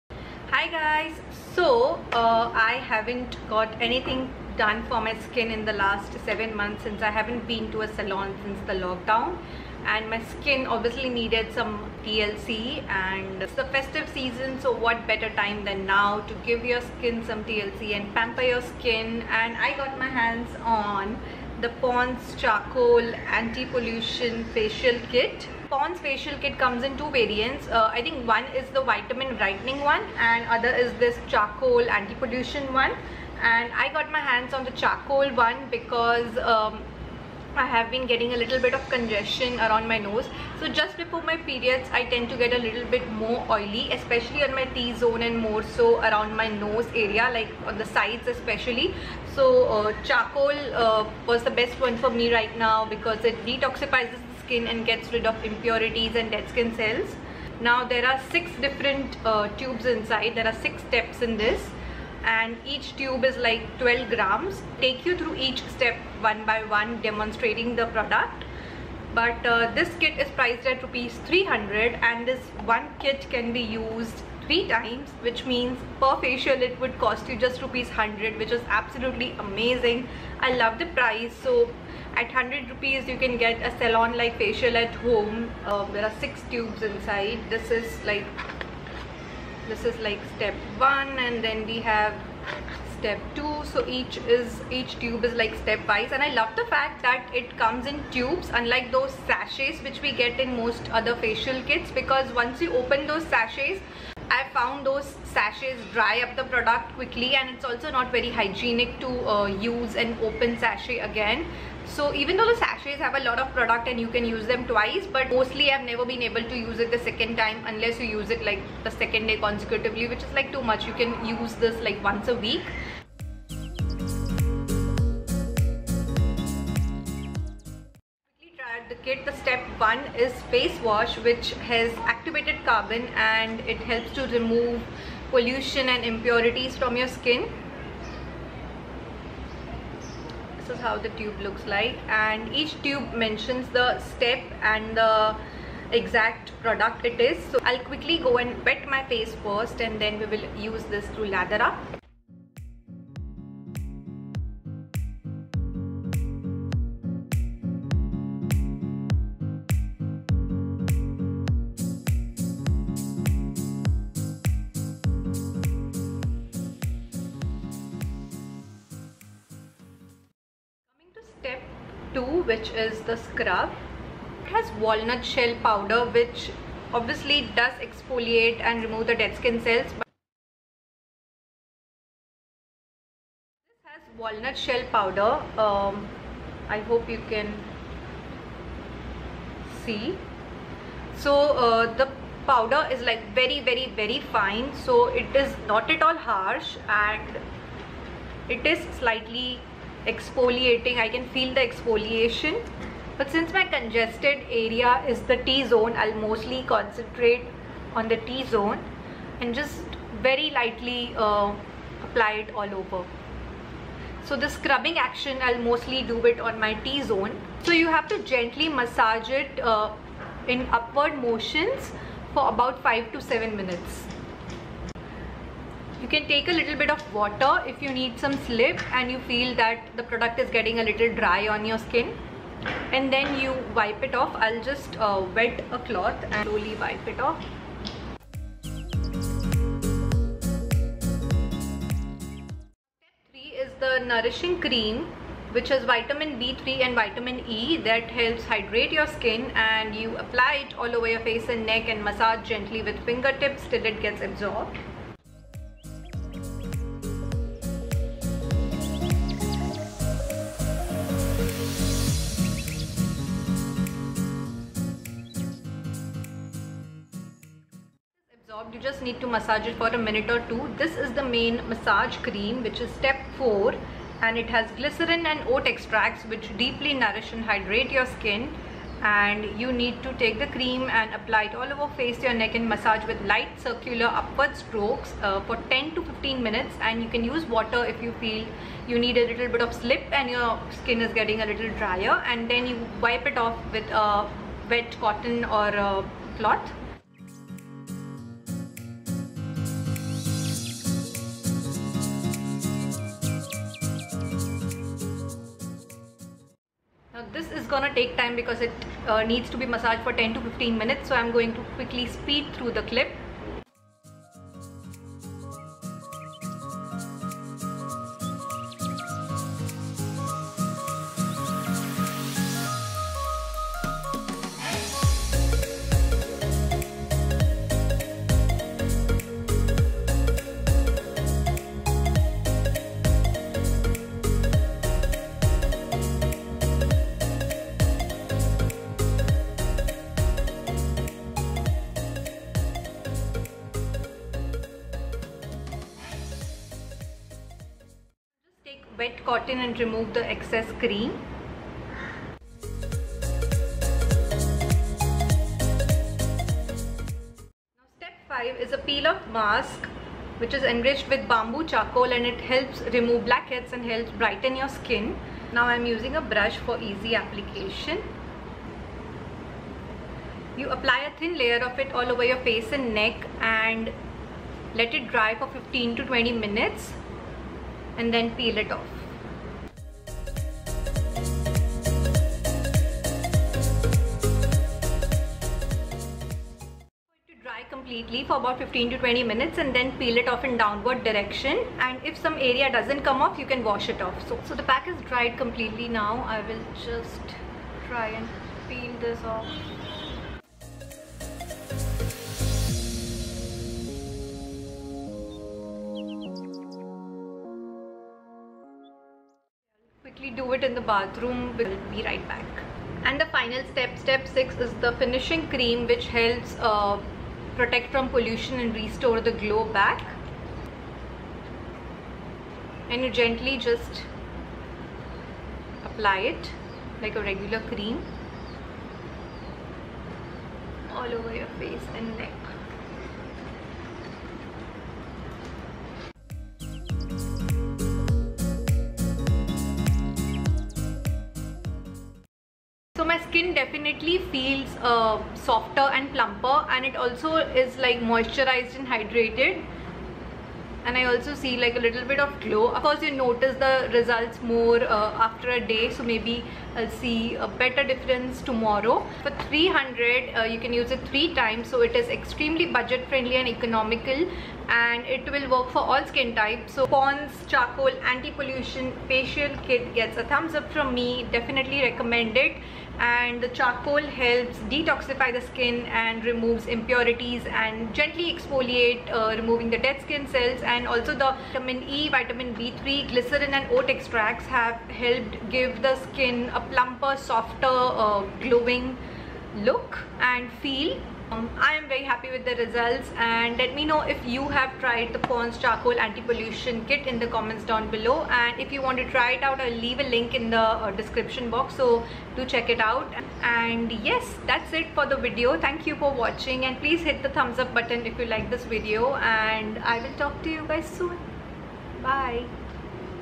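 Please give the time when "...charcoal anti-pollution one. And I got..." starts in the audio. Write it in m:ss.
0:31.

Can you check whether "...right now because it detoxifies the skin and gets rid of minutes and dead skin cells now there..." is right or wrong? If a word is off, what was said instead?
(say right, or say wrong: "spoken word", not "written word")
wrong: "impurities", not "minutes".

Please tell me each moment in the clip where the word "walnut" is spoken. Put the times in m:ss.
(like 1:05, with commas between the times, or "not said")
2:54, 3:04.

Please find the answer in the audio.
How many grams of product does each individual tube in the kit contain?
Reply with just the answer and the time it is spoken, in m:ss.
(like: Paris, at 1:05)
12 grams, at 1:03.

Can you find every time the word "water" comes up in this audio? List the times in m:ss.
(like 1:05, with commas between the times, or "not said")
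3:47, 4:47.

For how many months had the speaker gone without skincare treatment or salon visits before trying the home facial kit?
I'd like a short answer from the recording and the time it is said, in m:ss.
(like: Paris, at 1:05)
7, at 0:06.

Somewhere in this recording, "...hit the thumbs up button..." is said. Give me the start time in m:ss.
8:26.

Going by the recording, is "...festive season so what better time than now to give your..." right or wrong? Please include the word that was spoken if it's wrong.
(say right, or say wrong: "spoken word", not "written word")
right.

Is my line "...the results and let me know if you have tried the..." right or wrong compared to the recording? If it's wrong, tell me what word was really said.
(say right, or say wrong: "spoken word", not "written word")
right.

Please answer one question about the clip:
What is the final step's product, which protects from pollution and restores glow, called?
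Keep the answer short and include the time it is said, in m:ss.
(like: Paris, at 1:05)
Finishing cream, at 6:54.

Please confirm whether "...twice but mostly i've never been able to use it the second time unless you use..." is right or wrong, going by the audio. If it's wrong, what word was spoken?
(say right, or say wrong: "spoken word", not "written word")
right.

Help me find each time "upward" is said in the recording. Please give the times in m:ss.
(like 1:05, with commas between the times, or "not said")
3:40, 4:44.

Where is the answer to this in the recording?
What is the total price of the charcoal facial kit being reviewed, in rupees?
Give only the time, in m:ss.
1:10.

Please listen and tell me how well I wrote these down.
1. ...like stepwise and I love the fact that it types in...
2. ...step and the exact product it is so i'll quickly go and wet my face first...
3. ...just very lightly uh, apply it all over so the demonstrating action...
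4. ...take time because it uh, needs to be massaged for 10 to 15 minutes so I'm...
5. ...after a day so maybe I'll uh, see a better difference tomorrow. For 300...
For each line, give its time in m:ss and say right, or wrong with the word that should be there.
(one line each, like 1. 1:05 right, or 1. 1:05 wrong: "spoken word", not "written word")
1. 1:35 wrong: "comes", not "types"
2. 2:24 right
3. 3:29 wrong: "scrubbing", not "demonstrating"
4. 5:07 right
5. 7:35 right.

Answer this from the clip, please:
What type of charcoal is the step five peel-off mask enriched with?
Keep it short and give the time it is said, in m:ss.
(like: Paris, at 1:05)
Bamboo charcoal, at 6:01.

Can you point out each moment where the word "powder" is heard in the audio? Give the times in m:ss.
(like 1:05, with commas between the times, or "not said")
2:55, 3:04, 3:12.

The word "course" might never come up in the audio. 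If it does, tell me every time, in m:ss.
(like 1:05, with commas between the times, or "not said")
7:32.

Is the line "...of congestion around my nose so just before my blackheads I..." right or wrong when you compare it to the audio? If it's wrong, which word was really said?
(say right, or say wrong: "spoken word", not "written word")
wrong: "periods", not "blackheads".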